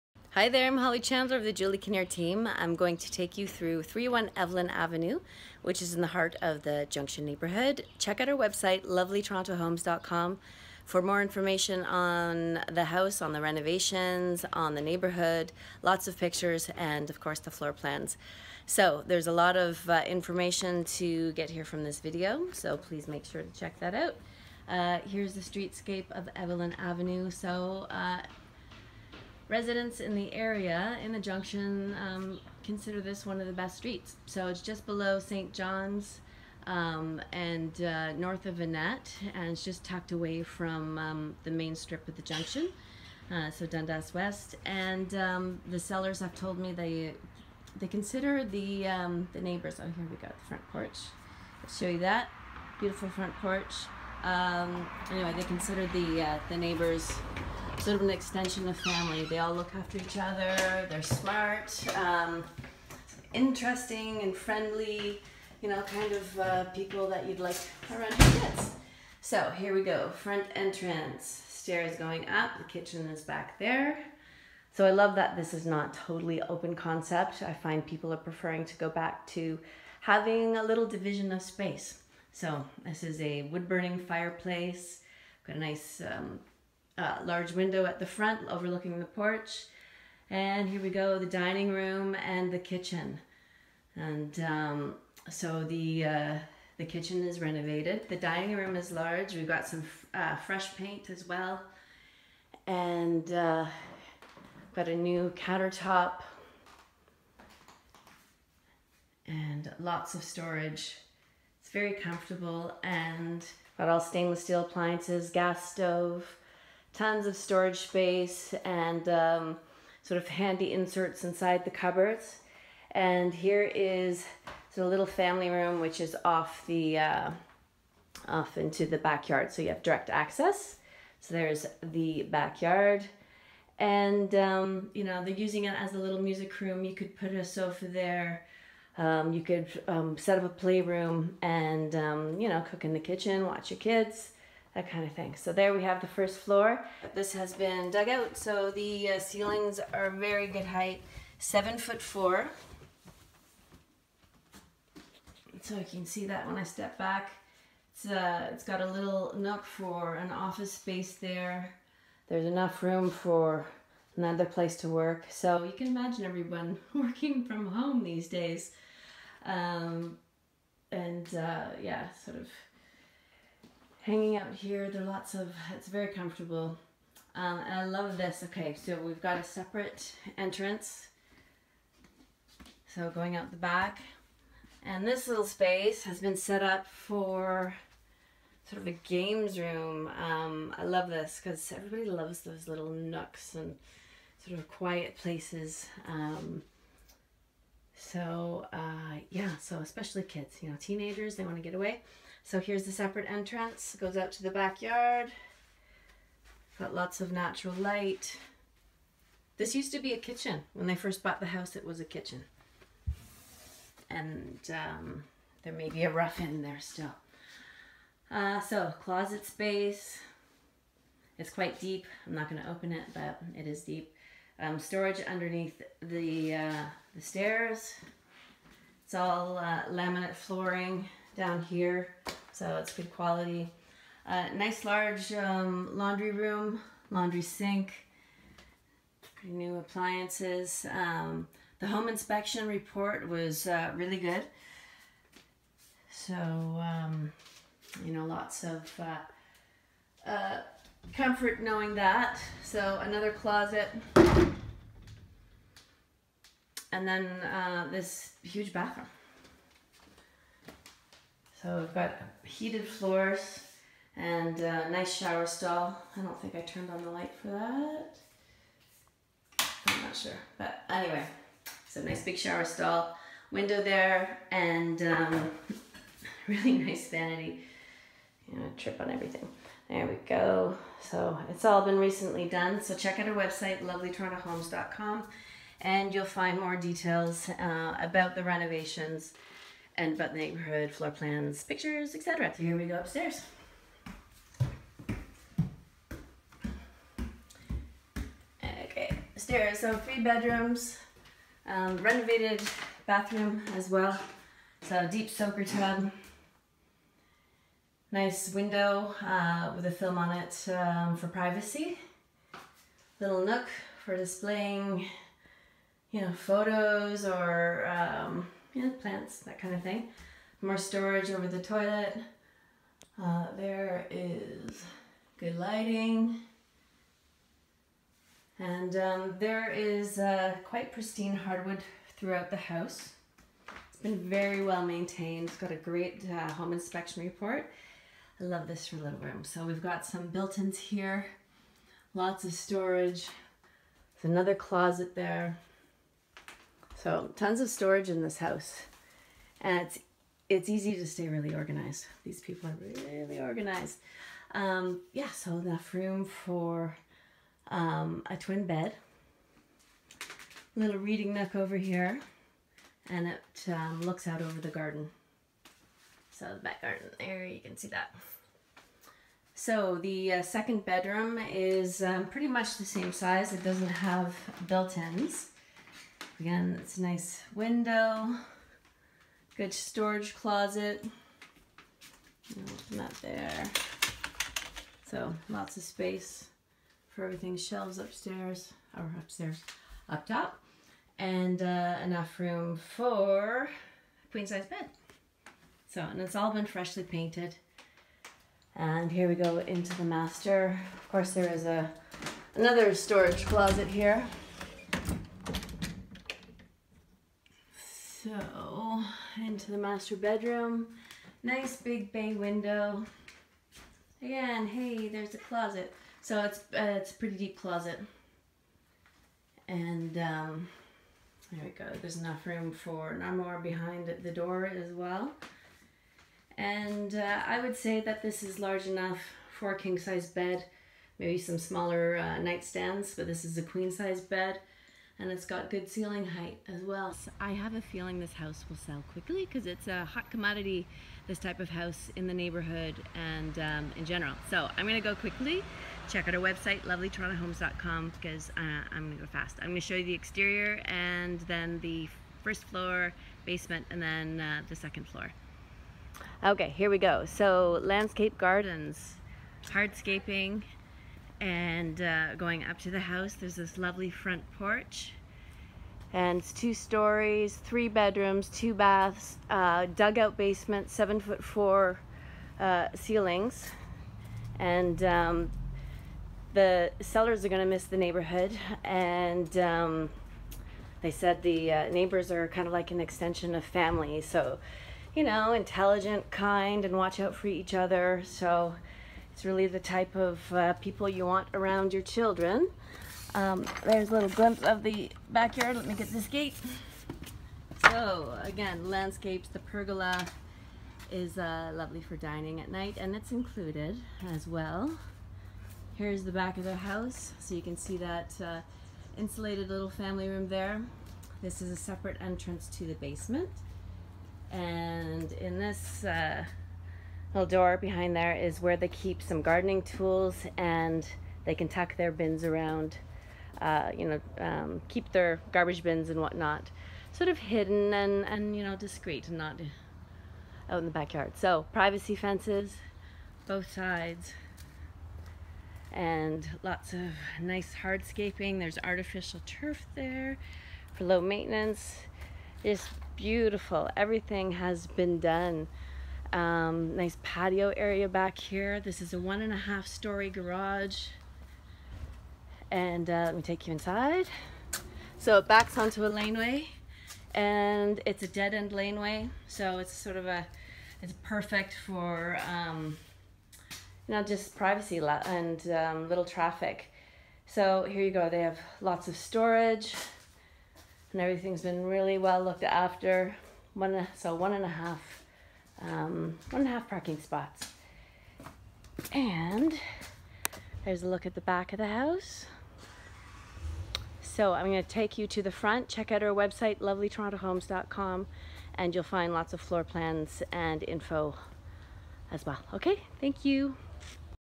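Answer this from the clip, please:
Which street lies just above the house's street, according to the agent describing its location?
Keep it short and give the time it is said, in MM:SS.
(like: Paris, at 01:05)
St. John's, at 00:35.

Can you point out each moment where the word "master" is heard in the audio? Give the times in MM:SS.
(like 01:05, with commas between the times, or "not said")
06:40, 06:49.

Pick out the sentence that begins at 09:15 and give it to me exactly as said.
So it backs onto a laneway and it's a dead end laneway.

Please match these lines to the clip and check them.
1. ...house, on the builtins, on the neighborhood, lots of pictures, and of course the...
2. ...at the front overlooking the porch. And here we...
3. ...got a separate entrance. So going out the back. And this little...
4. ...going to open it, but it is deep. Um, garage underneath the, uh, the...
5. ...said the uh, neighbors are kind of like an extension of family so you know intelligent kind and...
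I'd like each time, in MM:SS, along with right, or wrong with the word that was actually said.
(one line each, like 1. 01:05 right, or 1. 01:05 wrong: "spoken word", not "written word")
1. 00:12 wrong: "renovations", not "builtins"
2. 01:27 right
3. 02:59 right
4. 03:42 wrong: "storage", not "garage"
5. 08:01 right.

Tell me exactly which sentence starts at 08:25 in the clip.
Here's the back of the house.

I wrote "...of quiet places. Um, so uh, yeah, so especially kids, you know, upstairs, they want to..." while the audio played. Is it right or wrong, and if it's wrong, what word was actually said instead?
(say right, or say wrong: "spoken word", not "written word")
wrong: "teenagers", not "upstairs".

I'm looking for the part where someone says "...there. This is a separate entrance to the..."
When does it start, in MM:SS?
08:30.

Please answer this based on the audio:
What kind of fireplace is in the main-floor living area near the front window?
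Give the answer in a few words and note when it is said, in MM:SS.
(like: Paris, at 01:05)
Wood burning, at 01:23.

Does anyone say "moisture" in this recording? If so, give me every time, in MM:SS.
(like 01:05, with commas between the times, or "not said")
not said.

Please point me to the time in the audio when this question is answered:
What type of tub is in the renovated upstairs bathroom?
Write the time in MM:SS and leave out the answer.
05:05.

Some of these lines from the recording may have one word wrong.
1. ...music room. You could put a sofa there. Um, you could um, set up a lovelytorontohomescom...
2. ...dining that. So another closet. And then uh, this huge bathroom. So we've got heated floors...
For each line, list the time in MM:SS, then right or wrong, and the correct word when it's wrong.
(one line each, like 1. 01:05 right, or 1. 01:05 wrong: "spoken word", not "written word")
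1. 02:16 wrong: "playroom", not "lovelytorontohomescom"
2. 04:11 wrong: "knowing", not "dining".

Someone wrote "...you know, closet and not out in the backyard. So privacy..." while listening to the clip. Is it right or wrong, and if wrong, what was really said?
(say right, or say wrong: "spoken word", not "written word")
wrong: "discreet", not "closet".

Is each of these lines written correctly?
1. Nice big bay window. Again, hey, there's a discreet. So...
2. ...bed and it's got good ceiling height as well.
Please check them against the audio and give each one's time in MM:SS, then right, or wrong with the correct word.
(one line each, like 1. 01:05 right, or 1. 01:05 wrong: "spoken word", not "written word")
1. 06:51 wrong: "closet", not "discreet"
2. 07:14 right.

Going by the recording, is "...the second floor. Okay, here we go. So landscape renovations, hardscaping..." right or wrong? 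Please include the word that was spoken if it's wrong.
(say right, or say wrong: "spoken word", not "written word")
wrong: "gardens", not "renovations".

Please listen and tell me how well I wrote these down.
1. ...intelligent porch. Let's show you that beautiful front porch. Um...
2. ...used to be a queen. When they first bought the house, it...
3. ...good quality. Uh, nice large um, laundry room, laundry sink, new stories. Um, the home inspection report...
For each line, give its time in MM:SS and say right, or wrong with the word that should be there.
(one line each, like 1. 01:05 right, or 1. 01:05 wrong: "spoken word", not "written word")
1. 00:50 wrong: "front", not "intelligent"
2. 03:29 wrong: "kitchen", not "queen"
3. 03:52 wrong: "appliances", not "stories".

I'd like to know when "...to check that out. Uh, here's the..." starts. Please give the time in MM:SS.
00:23.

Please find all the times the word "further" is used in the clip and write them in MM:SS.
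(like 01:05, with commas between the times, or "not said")
not said.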